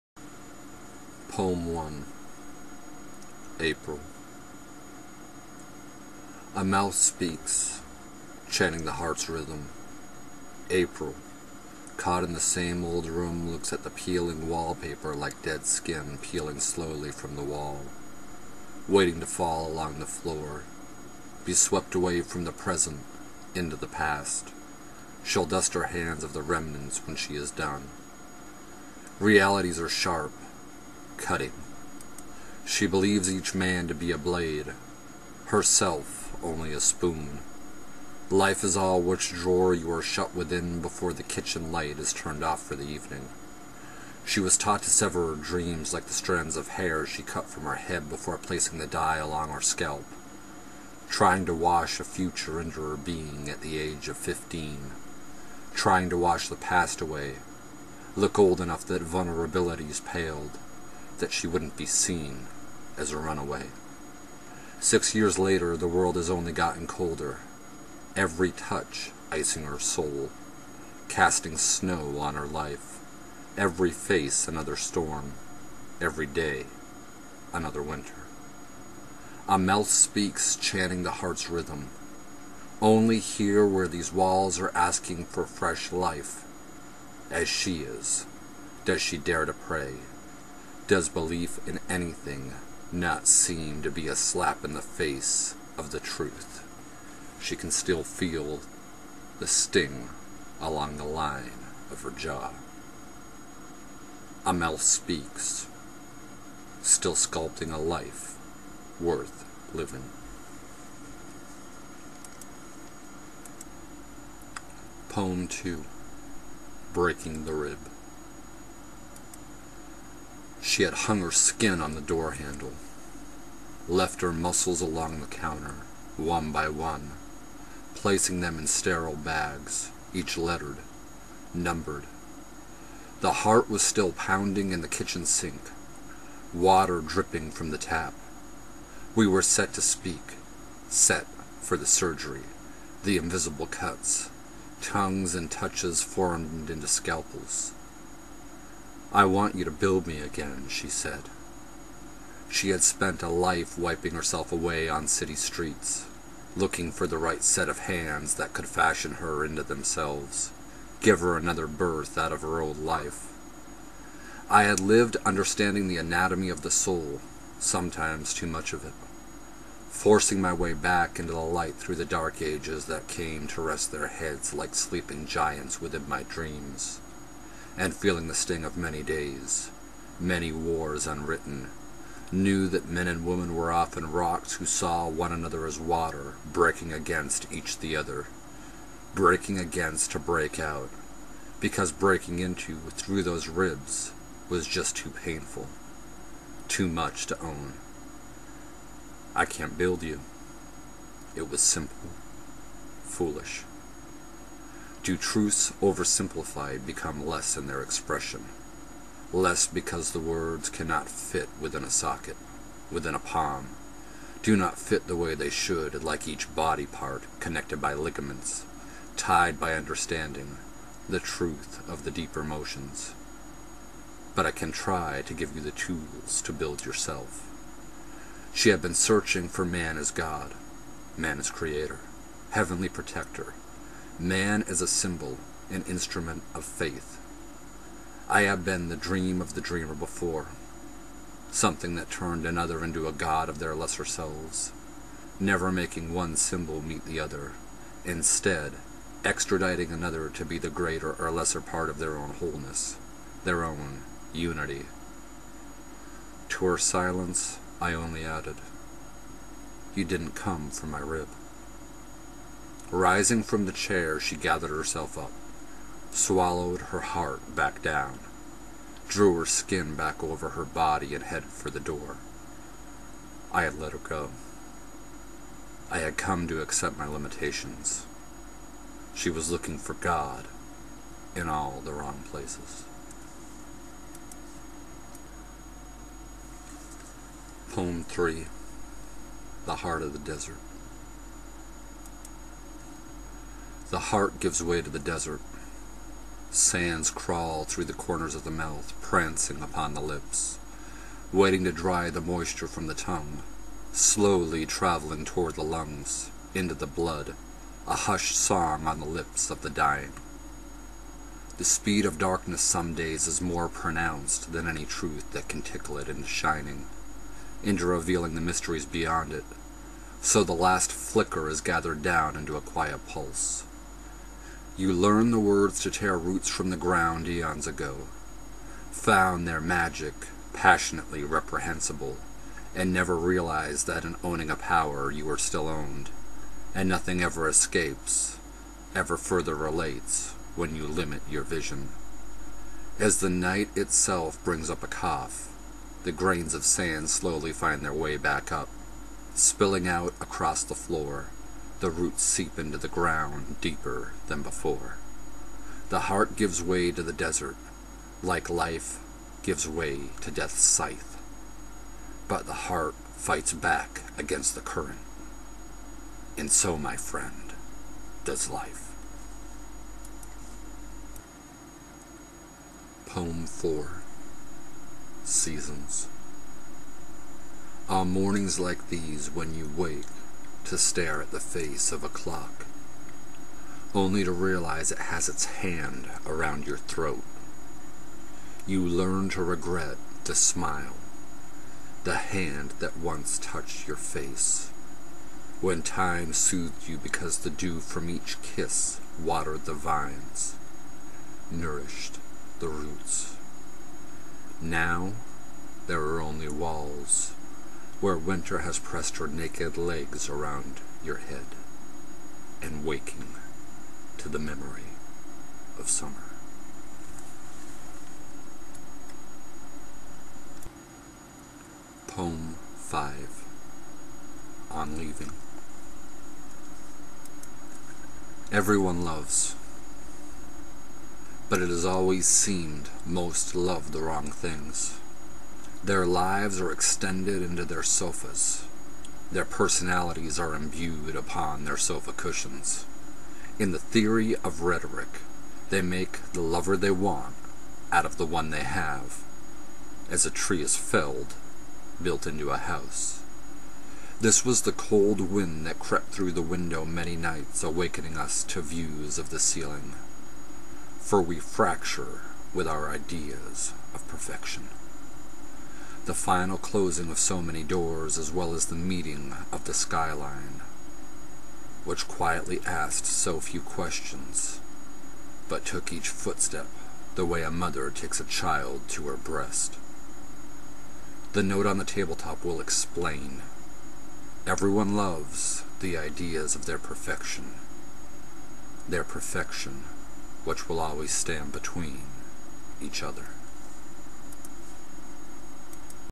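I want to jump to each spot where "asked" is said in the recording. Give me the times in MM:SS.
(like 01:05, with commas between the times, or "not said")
07:52.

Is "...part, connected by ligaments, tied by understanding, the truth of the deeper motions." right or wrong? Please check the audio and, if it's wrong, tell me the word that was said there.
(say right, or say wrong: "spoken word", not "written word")
right.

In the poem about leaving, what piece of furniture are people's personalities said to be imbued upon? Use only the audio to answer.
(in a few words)
sofa cushions.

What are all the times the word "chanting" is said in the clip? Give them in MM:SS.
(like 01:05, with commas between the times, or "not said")
00:08, 01:20.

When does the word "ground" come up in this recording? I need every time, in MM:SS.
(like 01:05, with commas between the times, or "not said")
05:26, 05:52.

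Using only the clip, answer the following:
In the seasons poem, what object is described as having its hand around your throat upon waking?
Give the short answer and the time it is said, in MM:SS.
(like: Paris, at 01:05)
a clock, at 06:22.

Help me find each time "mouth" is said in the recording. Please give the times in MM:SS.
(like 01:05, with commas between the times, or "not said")
00:06, 01:19, 04:58.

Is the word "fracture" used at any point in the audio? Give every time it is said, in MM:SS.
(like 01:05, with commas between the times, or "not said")
07:41.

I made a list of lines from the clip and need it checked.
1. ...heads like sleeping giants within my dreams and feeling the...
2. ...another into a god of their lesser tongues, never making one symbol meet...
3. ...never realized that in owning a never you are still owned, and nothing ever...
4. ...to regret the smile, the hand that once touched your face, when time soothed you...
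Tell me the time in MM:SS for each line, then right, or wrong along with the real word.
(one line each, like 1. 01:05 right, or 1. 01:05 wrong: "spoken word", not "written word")
1. 02:54 right
2. 04:02 wrong: "selves", not "tongues"
3. 05:32 wrong: "power", not "never"
4. 06:29 right.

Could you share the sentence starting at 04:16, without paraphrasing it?
To her silence I only added, You didn't come from my rib.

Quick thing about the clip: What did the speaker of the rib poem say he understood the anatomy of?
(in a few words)
the soul.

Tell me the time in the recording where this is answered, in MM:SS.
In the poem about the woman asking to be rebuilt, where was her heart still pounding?
02:14.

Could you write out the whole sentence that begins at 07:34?
This was the cold wind that crept through the window many nights, awakening us to views of the ceiling.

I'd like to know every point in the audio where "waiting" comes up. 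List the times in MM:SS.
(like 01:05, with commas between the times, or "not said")
00:18, 05:01.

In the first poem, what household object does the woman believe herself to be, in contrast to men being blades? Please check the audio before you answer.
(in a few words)
a spoon.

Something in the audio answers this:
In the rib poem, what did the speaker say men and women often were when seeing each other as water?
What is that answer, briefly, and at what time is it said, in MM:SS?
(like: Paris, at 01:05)
rocks, at 03:04.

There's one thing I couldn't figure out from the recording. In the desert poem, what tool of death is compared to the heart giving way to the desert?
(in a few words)
scythe.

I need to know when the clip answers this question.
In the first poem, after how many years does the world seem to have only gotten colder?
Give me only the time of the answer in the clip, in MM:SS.
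01:04.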